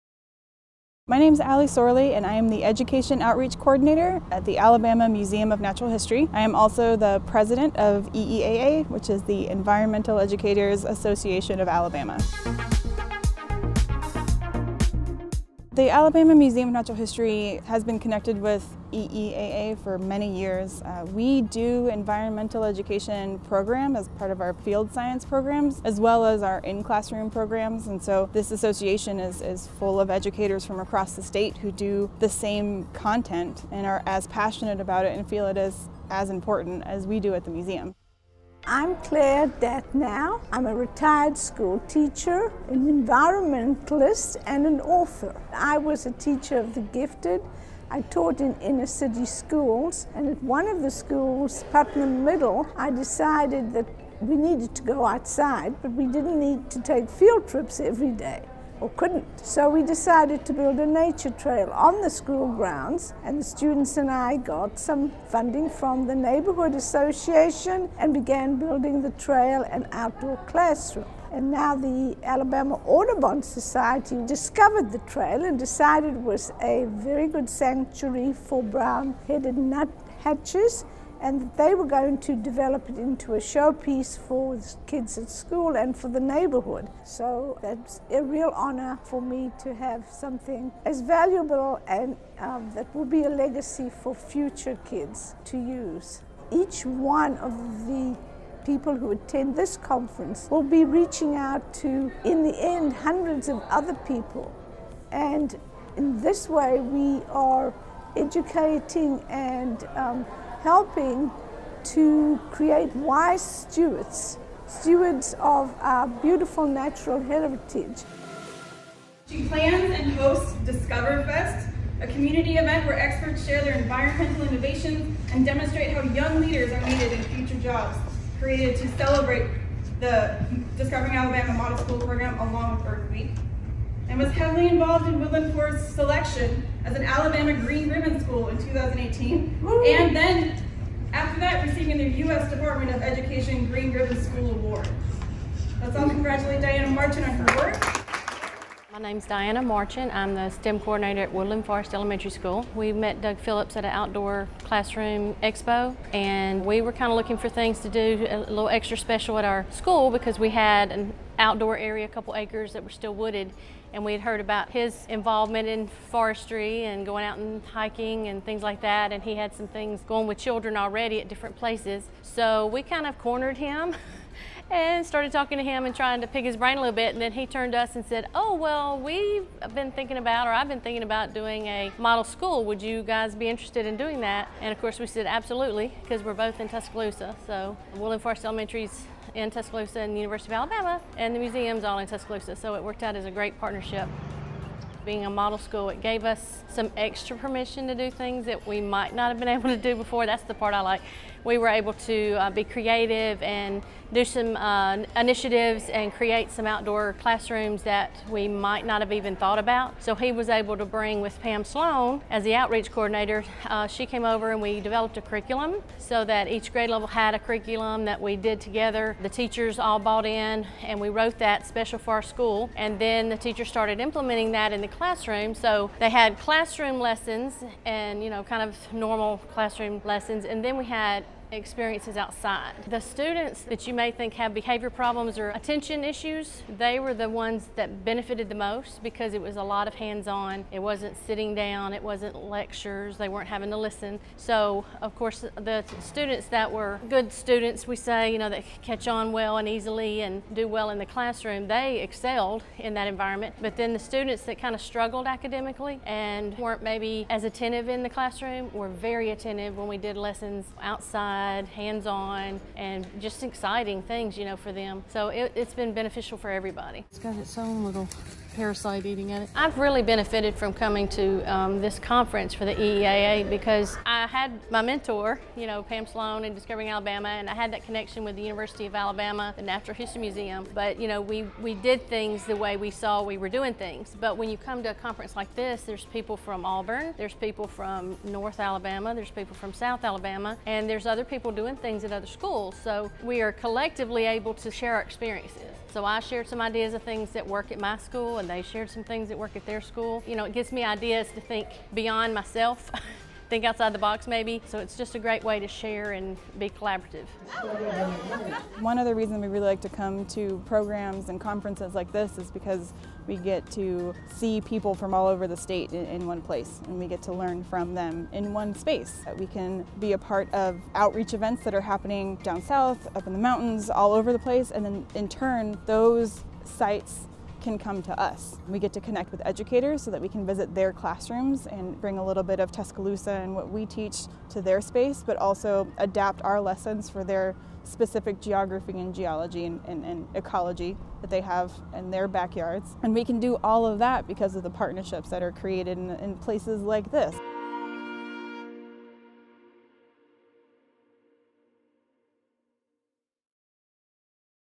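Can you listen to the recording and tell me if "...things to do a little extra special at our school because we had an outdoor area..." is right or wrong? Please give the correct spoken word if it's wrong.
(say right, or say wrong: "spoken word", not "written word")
right.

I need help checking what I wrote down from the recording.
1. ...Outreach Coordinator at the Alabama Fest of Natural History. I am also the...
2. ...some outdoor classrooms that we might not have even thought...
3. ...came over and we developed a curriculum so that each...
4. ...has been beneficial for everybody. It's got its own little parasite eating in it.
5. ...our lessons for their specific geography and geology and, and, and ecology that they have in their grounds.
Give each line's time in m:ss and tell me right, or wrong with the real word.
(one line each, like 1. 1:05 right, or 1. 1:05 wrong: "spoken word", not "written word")
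1. 0:03 wrong: "Museum", not "Fest"
2. 3:26 right
3. 3:34 right
4. 4:25 right
5. 5:36 wrong: "backyards", not "grounds".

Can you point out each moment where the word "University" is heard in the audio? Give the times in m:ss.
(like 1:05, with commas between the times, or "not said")
3:10, 4:38.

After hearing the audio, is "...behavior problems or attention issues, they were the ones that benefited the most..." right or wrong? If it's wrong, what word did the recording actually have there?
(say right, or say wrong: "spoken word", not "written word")
right.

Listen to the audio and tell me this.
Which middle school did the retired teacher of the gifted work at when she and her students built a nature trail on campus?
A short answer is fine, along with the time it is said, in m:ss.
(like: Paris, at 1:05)
Putnam Middle, at 0:51.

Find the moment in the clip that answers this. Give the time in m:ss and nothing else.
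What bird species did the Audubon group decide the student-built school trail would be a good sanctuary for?
1:18.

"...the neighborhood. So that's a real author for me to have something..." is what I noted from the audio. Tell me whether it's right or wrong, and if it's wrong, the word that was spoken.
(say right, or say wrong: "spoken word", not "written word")
wrong: "honor", not "author".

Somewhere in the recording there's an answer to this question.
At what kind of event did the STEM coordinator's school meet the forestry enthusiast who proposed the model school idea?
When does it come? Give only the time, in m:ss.
2:33.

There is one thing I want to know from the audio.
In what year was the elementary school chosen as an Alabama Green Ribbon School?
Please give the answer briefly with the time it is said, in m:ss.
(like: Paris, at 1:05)
2018, at 2:18.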